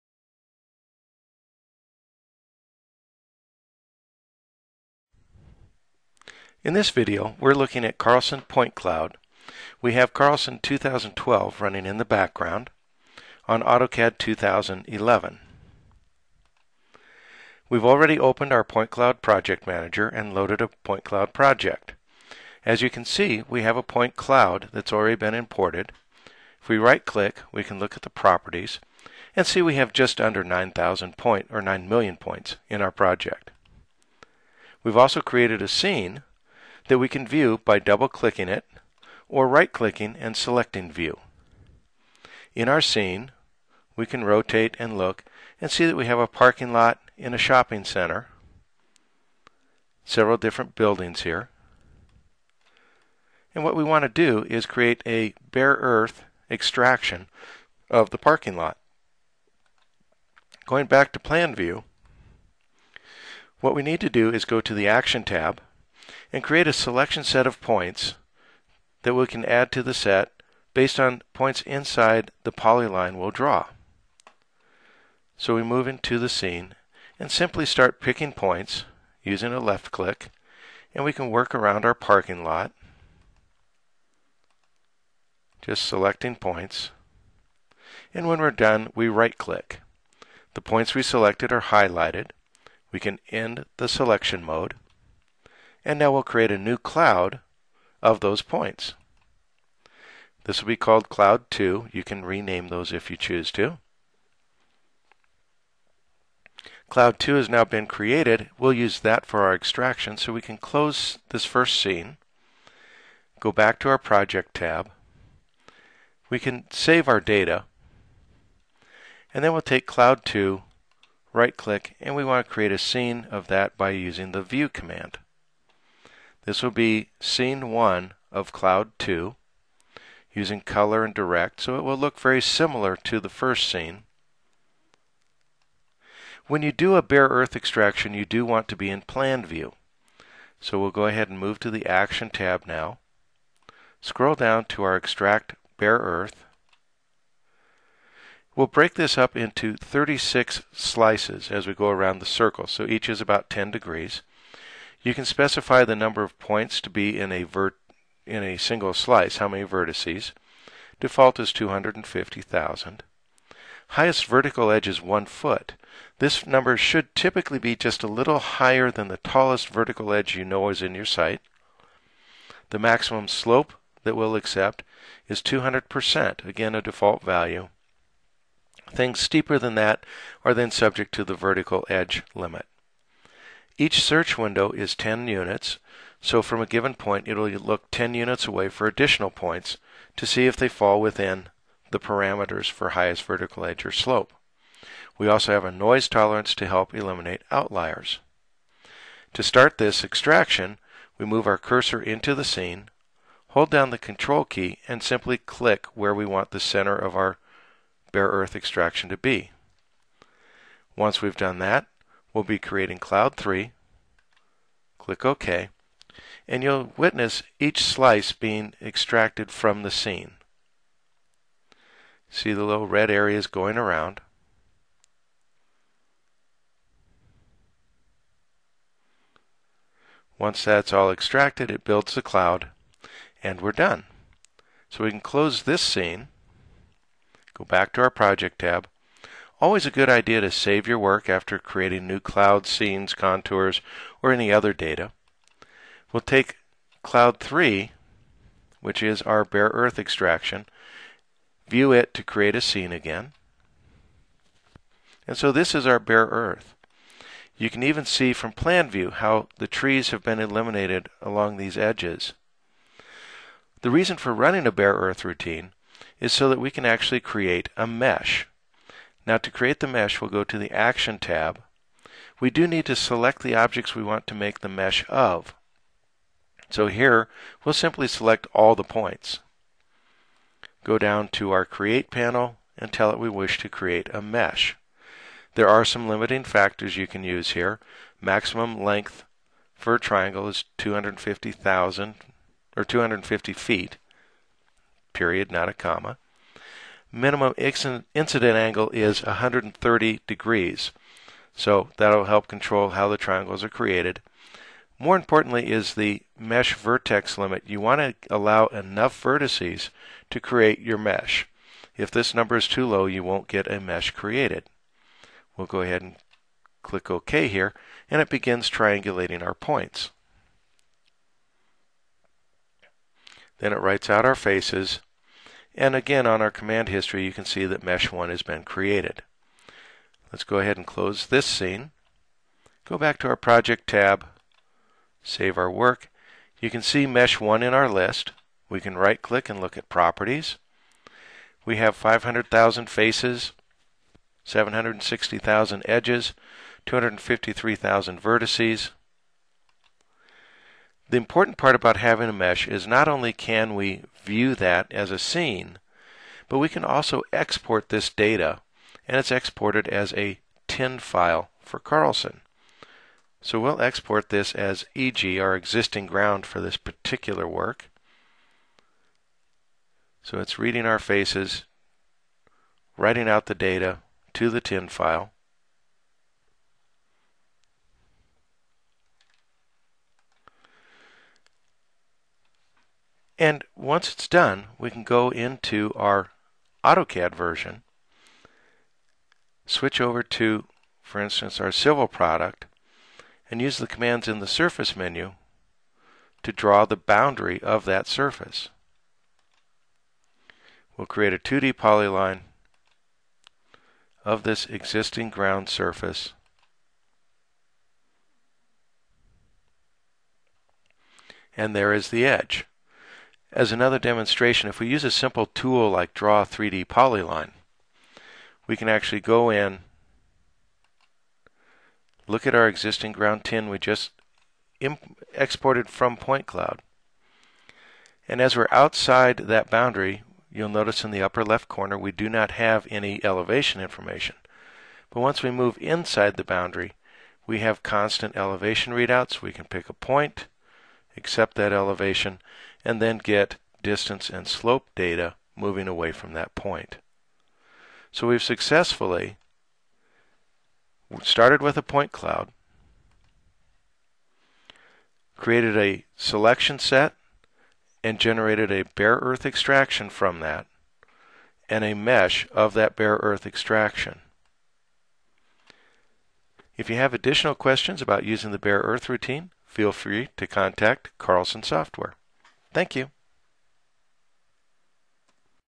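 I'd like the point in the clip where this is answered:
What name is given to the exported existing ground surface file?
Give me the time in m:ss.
6:04.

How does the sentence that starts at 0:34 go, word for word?
We've also created a scene that we can view by double-clicking it or right-clicking and selecting View.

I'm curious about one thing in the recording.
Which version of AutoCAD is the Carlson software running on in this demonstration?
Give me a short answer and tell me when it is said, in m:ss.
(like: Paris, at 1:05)
AutoCAD 2011, at 0:13.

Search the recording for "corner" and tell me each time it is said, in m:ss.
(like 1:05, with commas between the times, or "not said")
7:11.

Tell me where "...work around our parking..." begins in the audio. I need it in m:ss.
1:21.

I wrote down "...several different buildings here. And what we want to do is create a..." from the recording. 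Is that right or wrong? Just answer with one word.
right.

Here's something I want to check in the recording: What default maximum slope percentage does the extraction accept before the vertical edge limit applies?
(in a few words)
200%.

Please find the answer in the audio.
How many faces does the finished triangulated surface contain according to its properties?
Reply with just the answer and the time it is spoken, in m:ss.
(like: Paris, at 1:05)
500,000, at 5:41.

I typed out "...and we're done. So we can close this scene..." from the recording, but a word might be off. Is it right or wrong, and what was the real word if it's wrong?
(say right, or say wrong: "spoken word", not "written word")
right.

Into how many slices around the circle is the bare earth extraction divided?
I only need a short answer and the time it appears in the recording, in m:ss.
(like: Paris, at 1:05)
36, at 2:29.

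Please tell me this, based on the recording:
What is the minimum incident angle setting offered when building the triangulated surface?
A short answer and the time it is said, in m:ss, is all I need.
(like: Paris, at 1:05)
130 degrees, at 4:59.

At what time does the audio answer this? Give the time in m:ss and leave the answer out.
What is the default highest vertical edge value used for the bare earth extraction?
2:45.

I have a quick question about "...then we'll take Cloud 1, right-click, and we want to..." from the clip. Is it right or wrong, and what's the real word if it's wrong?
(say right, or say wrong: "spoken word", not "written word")
wrong: "2", not "1".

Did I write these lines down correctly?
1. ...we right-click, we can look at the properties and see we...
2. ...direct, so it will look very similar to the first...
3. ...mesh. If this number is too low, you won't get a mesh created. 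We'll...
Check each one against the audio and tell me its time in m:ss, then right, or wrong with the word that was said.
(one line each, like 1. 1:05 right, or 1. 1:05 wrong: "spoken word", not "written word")
1. 0:26 right
2. 2:11 right
3. 5:10 right.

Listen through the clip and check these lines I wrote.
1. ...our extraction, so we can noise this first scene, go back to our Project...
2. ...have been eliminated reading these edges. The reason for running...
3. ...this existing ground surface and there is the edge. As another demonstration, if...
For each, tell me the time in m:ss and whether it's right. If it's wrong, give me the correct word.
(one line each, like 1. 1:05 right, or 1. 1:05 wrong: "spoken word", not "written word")
1. 1:49 wrong: "close", not "noise"
2. 4:20 wrong: "along", not "reading"
3. 6:44 right.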